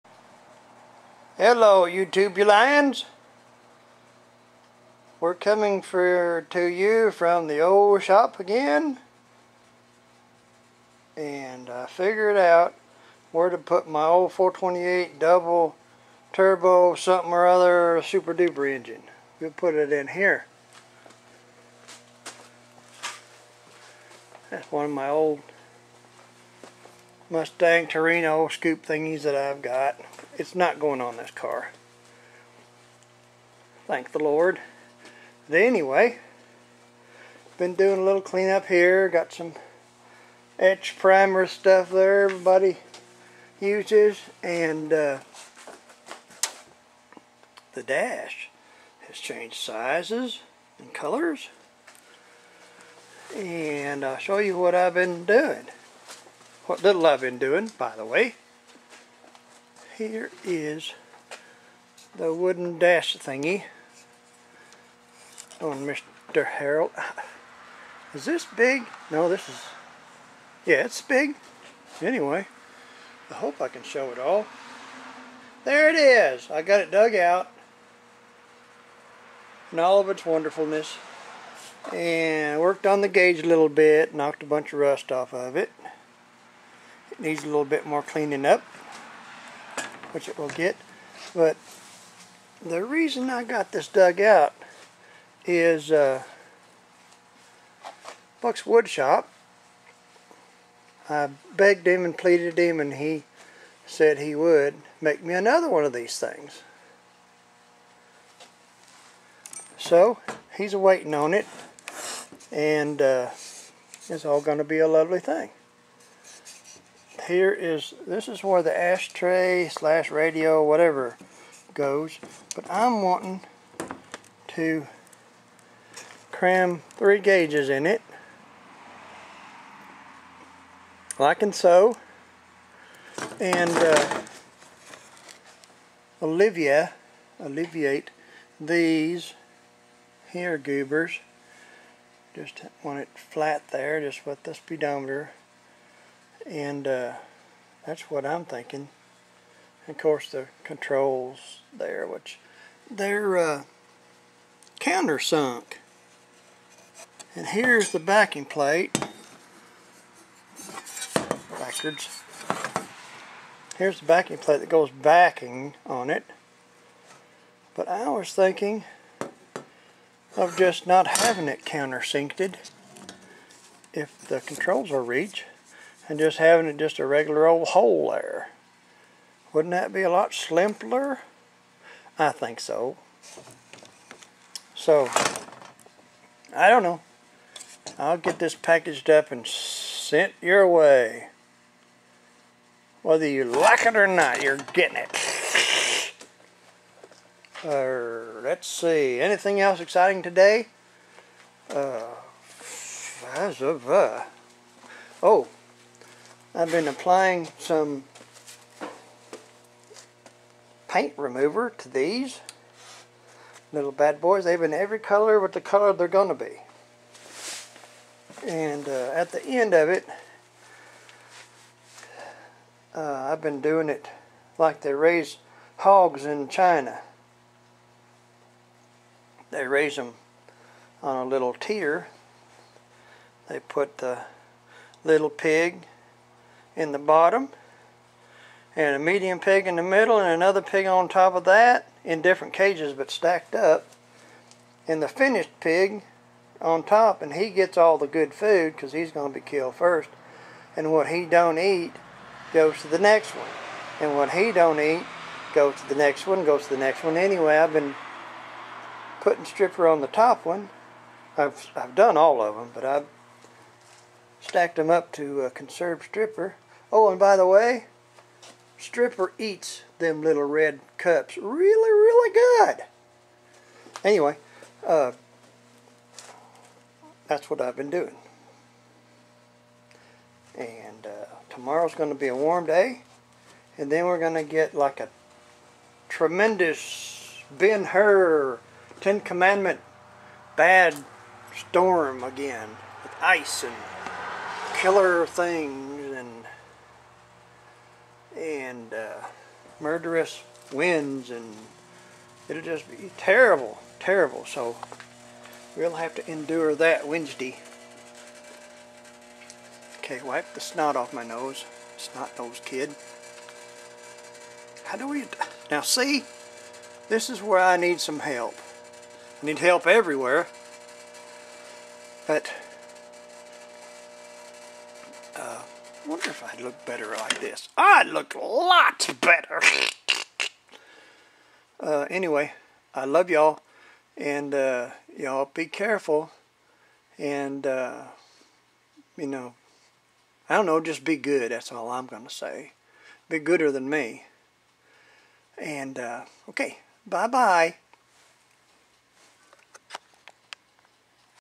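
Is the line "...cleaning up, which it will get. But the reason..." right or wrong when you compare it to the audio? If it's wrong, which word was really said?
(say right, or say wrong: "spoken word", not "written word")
right.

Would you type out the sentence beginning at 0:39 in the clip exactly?
Got some etch primer stuff there everybody uses.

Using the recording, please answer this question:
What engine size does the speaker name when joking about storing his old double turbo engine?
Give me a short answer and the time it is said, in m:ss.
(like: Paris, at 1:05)
428, at 0:14.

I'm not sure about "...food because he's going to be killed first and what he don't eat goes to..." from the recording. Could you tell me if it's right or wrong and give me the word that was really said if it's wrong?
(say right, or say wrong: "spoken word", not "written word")
right.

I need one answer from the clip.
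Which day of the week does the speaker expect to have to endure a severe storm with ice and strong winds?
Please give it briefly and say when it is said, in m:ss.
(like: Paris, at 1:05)
Wednesday, at 5:07.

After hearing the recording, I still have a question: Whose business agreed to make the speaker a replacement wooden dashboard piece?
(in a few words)
Buck's Wood Shop.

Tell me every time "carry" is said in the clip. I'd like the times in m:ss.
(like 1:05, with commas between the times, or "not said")
not said.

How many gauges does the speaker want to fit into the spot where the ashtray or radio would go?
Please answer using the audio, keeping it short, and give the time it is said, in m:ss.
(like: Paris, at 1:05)
3, at 2:06.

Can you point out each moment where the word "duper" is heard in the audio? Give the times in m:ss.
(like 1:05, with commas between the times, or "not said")
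0:18.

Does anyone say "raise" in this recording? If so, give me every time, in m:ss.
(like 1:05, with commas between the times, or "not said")
3:44, 3:49.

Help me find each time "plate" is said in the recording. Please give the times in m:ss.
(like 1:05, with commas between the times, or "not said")
2:38, 2:44.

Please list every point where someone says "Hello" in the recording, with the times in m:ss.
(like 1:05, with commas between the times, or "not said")
0:01.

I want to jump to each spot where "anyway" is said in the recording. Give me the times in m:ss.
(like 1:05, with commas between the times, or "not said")
0:35, 1:12, 4:17, 4:34, 5:32.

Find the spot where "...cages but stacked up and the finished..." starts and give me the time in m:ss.
4:02.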